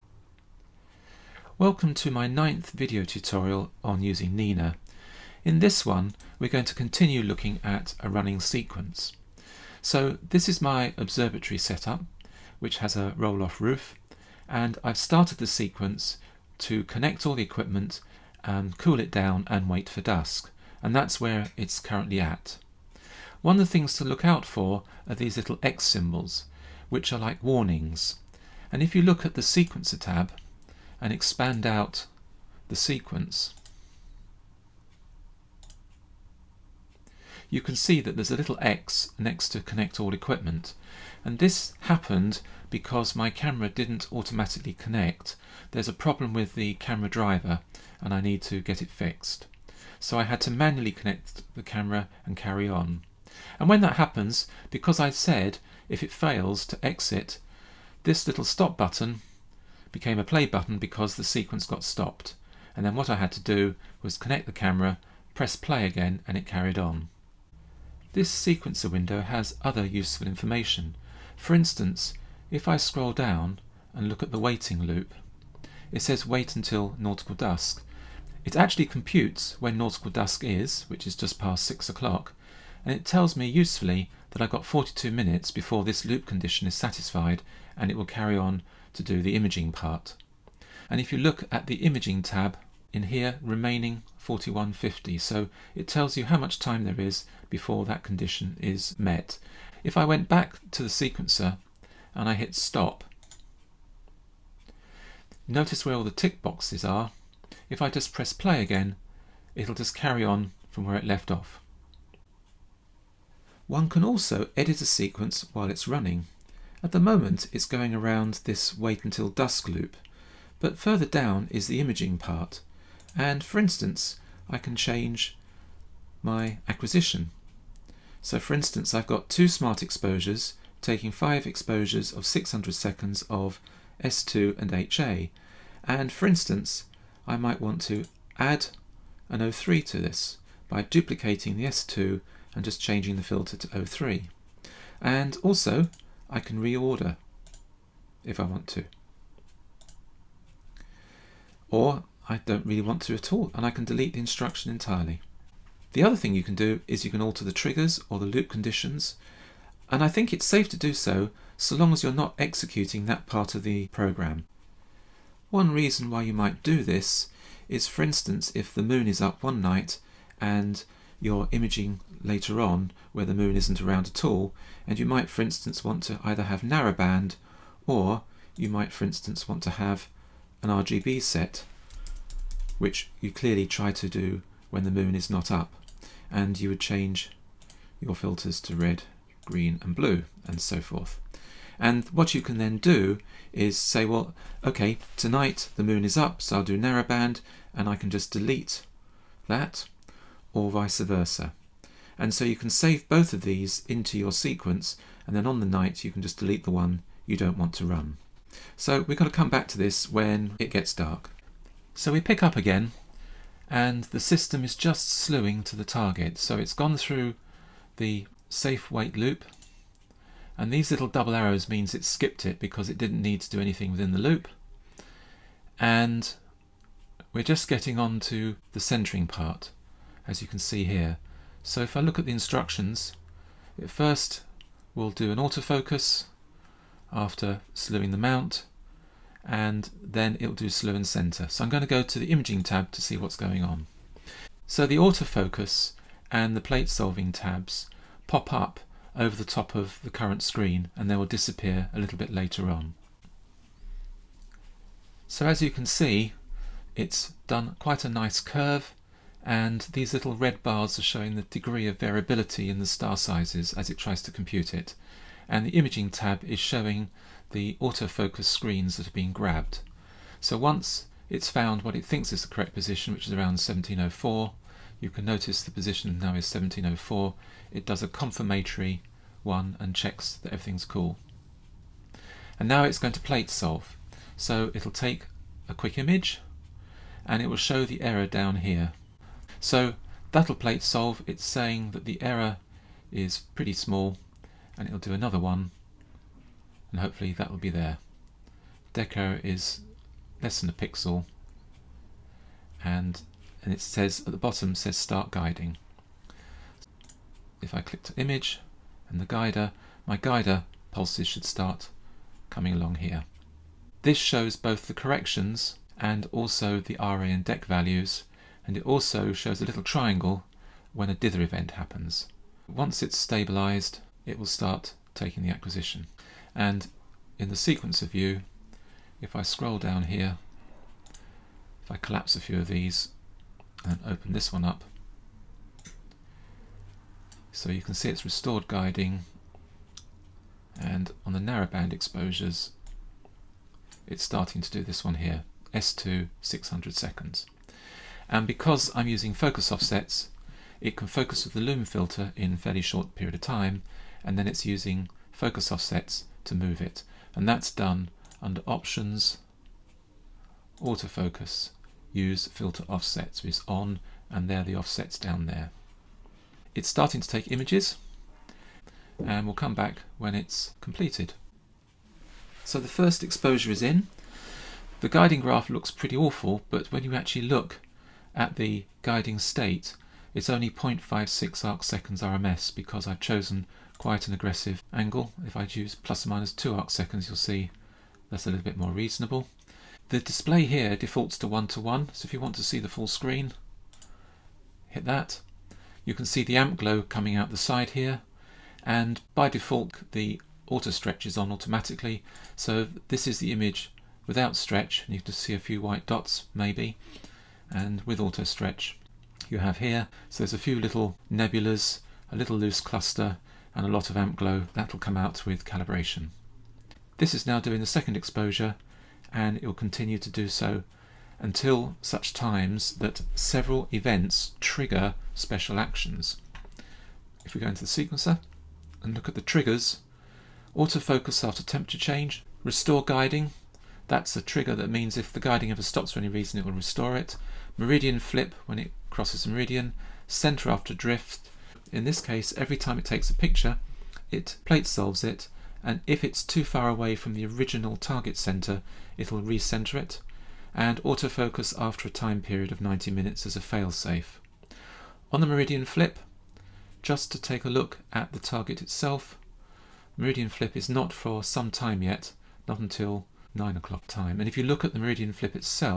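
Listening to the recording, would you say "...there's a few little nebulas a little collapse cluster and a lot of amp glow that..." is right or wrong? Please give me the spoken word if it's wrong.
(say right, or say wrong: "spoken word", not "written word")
wrong: "loose", not "collapse".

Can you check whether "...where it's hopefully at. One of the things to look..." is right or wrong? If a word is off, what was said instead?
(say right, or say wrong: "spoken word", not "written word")
wrong: "currently", not "hopefully".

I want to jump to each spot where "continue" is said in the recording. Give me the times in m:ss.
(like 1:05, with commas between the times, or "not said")
0:06, 6:59.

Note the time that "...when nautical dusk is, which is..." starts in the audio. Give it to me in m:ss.
1:19.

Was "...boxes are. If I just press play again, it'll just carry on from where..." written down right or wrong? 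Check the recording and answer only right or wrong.
right.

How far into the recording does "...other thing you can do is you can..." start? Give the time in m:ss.
2:36.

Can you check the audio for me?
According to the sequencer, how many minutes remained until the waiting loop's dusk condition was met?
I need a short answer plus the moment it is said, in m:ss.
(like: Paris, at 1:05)
42, at 1:24.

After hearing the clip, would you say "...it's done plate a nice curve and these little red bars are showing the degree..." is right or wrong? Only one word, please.
wrong.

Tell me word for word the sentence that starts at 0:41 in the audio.
And this happened because my camera didn't automatically connect.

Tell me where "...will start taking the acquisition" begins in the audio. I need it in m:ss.
5:24.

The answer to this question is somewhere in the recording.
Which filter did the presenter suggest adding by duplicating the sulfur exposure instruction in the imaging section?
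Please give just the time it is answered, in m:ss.
2:19.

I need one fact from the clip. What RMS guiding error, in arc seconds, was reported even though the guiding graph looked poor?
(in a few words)
0.56.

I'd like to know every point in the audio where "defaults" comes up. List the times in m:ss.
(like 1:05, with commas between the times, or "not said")
6:30, 6:39.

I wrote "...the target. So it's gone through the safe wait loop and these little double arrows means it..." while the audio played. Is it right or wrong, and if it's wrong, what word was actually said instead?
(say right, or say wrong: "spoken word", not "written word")
right.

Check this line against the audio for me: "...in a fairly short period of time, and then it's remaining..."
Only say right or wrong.
wrong.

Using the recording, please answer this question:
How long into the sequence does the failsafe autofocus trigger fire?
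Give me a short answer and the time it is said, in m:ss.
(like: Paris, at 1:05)
90 minutes, at 7:32.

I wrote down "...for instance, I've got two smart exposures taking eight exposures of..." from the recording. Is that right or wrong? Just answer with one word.
wrong.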